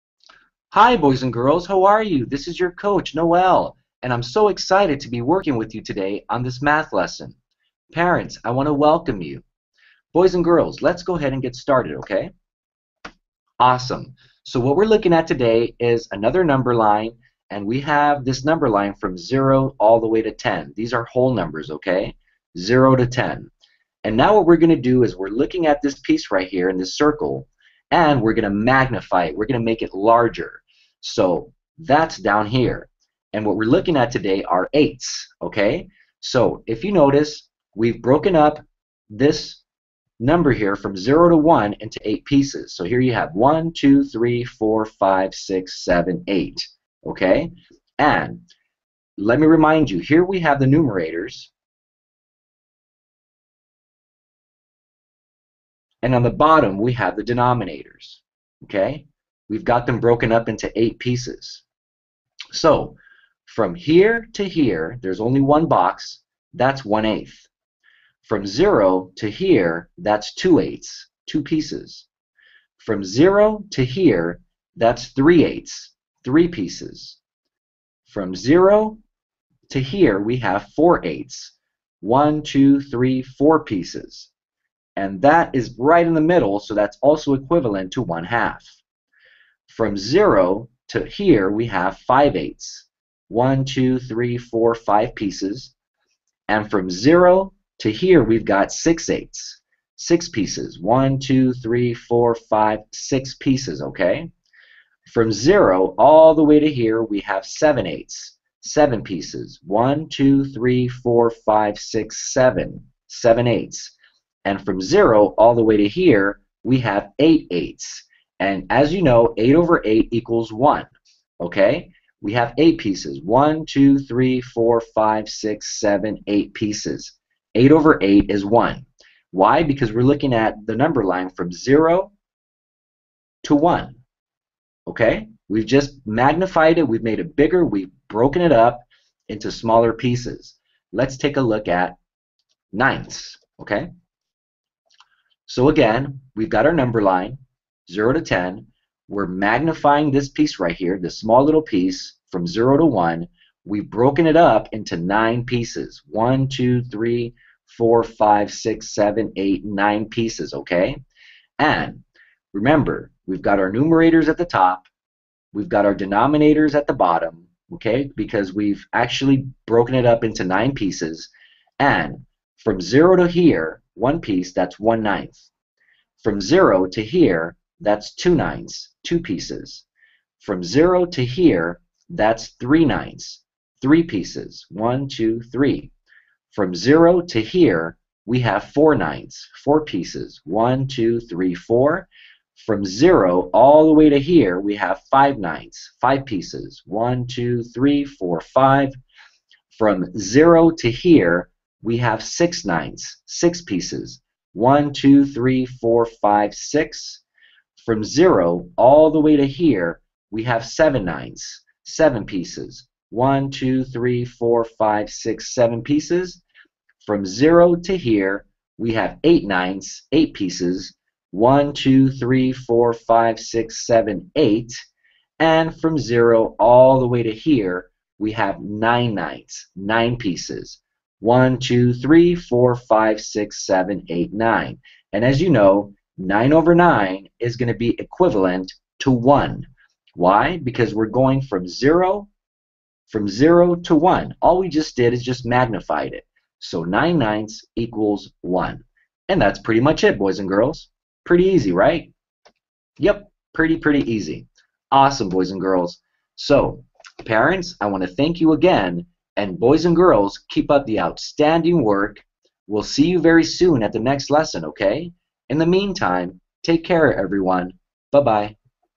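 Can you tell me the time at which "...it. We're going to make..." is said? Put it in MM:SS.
00:29.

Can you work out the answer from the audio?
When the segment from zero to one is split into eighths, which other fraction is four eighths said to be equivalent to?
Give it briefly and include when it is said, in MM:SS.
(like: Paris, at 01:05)
1/2, at 01:28.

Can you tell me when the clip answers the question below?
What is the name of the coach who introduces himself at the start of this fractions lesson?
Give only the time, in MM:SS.
00:03.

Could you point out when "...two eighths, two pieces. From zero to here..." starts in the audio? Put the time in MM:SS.
01:10.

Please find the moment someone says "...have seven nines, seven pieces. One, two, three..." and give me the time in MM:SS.
03:30.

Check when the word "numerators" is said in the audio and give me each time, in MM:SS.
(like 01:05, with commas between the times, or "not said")
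00:50, 02:43.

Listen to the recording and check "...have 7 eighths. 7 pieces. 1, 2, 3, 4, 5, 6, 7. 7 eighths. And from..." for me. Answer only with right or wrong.
right.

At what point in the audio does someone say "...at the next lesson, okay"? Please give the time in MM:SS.
04:23.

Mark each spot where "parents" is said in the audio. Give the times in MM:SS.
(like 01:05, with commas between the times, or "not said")
00:07, 04:17.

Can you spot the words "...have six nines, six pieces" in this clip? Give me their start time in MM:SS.
03:21.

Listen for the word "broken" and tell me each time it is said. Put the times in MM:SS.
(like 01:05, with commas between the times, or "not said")
00:38, 00:59, 02:18, 02:33, 02:49.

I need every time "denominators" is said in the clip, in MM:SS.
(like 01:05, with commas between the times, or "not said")
00:57, 02:45.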